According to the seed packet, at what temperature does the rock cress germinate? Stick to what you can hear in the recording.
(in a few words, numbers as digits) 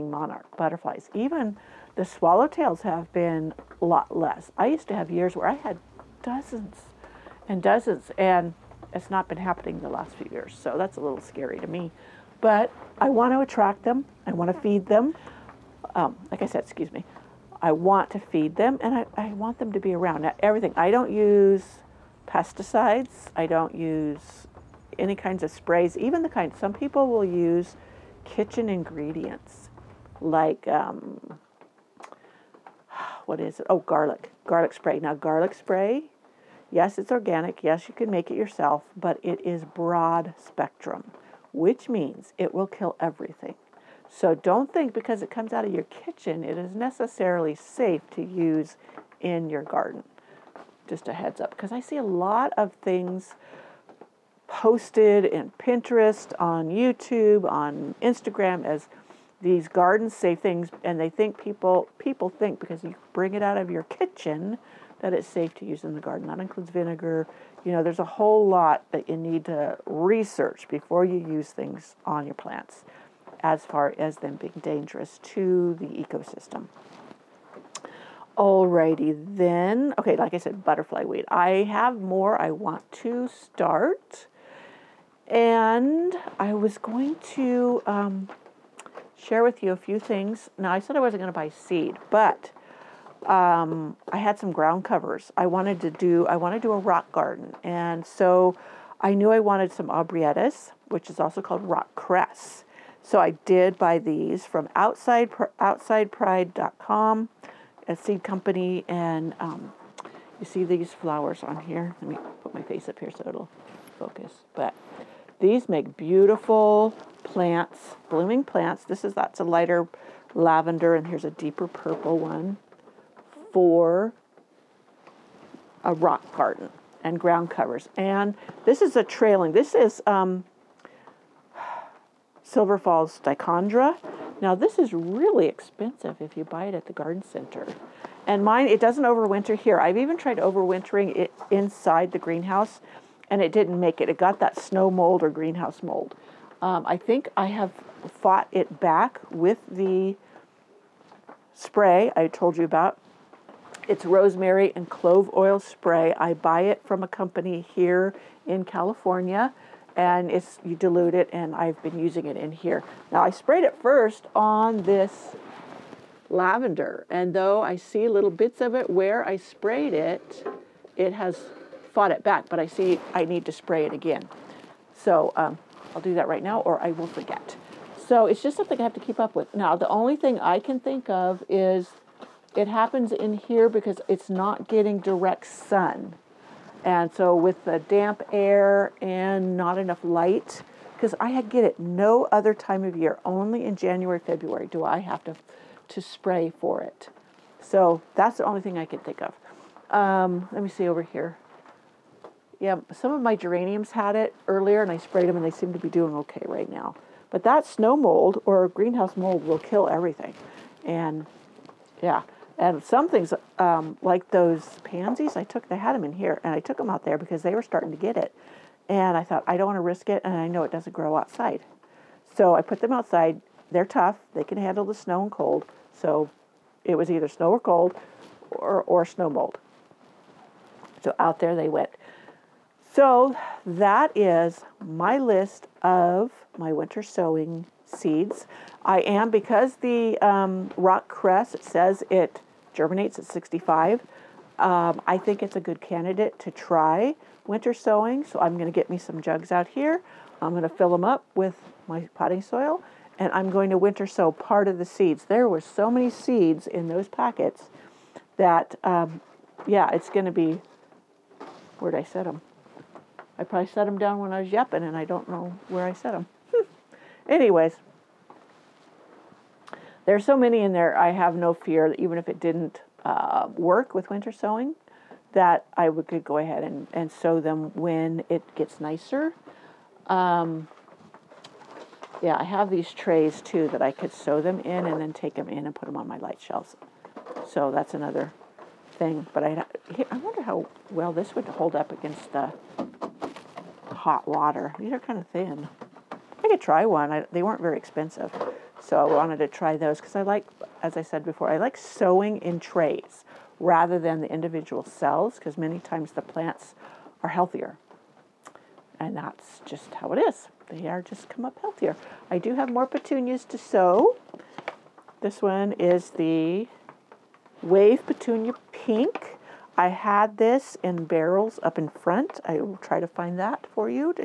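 65.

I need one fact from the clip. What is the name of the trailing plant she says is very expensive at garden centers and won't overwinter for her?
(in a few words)
Silver Falls Dichondra.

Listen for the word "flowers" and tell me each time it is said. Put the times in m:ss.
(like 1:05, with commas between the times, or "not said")
1:50.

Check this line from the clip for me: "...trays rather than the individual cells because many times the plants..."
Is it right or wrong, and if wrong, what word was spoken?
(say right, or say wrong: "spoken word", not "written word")
right.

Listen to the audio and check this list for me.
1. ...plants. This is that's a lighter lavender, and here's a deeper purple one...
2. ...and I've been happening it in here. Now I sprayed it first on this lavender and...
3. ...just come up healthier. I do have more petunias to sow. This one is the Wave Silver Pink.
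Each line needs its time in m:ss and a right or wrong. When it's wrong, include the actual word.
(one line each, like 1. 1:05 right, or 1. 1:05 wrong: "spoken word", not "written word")
1. 1:58 right
2. 2:41 wrong: "using", not "happening"
3. 5:11 wrong: "Petunia", not "Silver".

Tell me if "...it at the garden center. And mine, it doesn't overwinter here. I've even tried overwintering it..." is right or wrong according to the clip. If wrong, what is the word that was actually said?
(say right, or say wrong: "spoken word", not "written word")
right.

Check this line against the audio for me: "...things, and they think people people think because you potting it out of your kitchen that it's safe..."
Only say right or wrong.
wrong.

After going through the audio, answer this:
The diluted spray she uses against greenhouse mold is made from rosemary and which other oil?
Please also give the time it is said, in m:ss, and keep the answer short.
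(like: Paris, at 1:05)
Clove oil, at 2:34.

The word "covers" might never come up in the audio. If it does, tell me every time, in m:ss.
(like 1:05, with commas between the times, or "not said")
1:34, 2:07.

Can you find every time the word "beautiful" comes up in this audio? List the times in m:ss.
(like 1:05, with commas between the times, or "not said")
1:55.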